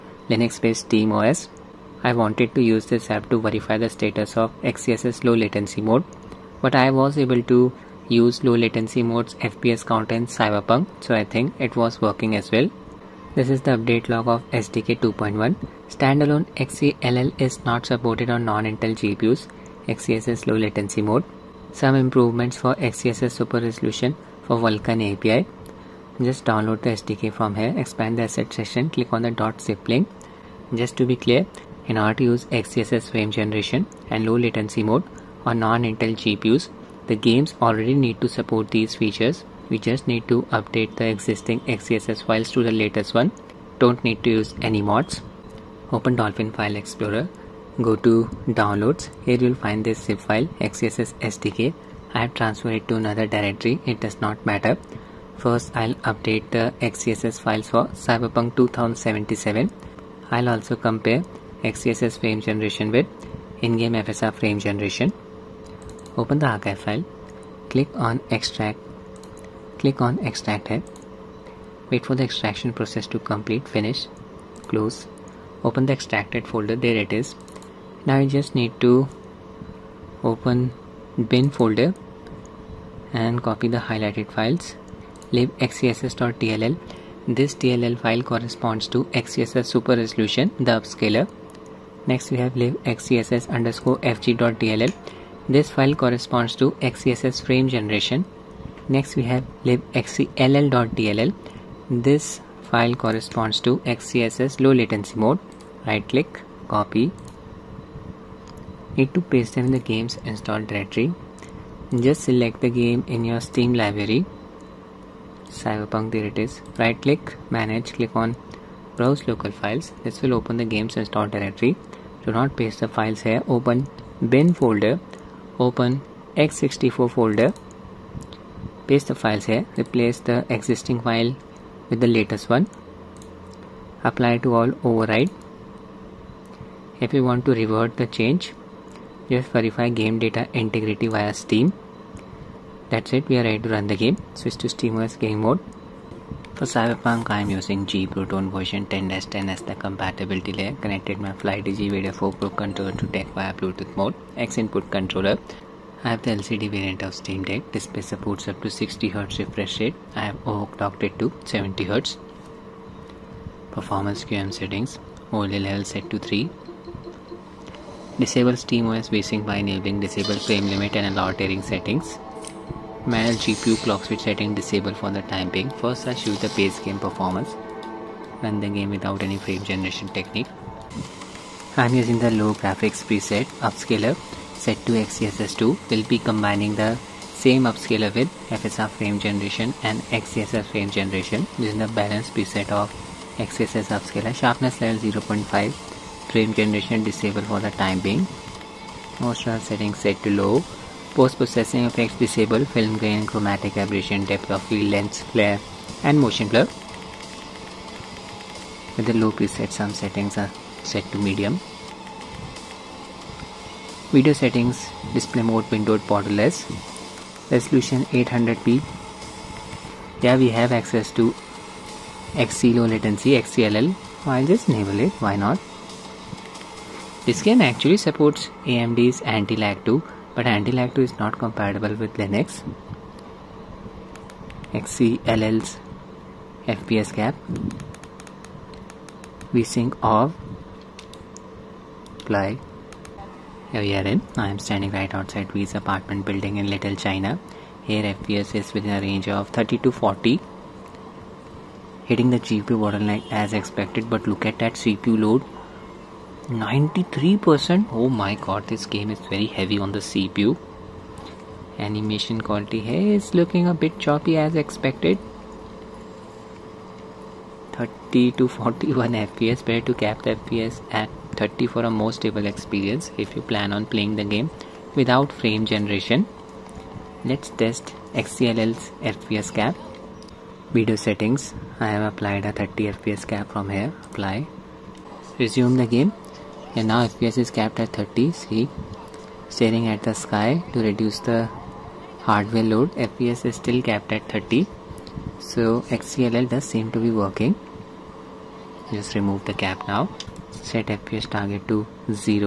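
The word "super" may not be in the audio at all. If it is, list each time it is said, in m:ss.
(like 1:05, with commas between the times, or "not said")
0:23, 1:29.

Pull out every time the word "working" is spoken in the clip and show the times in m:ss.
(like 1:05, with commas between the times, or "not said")
0:12, 4:57.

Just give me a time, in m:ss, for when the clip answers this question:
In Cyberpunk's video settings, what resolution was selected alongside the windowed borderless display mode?
3:38.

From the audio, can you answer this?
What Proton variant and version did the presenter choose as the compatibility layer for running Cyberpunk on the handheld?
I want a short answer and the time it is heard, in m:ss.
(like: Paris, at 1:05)
G-Proton 10-10, at 2:27.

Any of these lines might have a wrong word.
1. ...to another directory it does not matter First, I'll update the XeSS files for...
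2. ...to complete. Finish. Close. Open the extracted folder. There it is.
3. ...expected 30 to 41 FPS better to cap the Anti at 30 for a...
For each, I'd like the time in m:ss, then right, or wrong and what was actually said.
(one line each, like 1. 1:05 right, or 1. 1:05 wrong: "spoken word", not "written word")
1. 0:52 right
2. 1:13 right
3. 4:24 wrong: "FPS", not "Anti".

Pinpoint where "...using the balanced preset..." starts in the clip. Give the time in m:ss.
3:11.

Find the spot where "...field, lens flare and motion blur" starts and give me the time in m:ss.
3:24.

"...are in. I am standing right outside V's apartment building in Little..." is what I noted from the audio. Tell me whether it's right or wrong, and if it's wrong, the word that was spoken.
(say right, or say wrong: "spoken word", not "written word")
right.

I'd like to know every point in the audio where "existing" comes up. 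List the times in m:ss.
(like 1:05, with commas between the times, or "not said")
0:41, 2:10.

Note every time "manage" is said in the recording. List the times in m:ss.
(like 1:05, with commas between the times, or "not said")
1:57, 2:53.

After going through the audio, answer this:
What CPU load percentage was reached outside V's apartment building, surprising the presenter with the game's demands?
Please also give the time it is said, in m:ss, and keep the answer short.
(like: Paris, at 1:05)
93%, at 4:16.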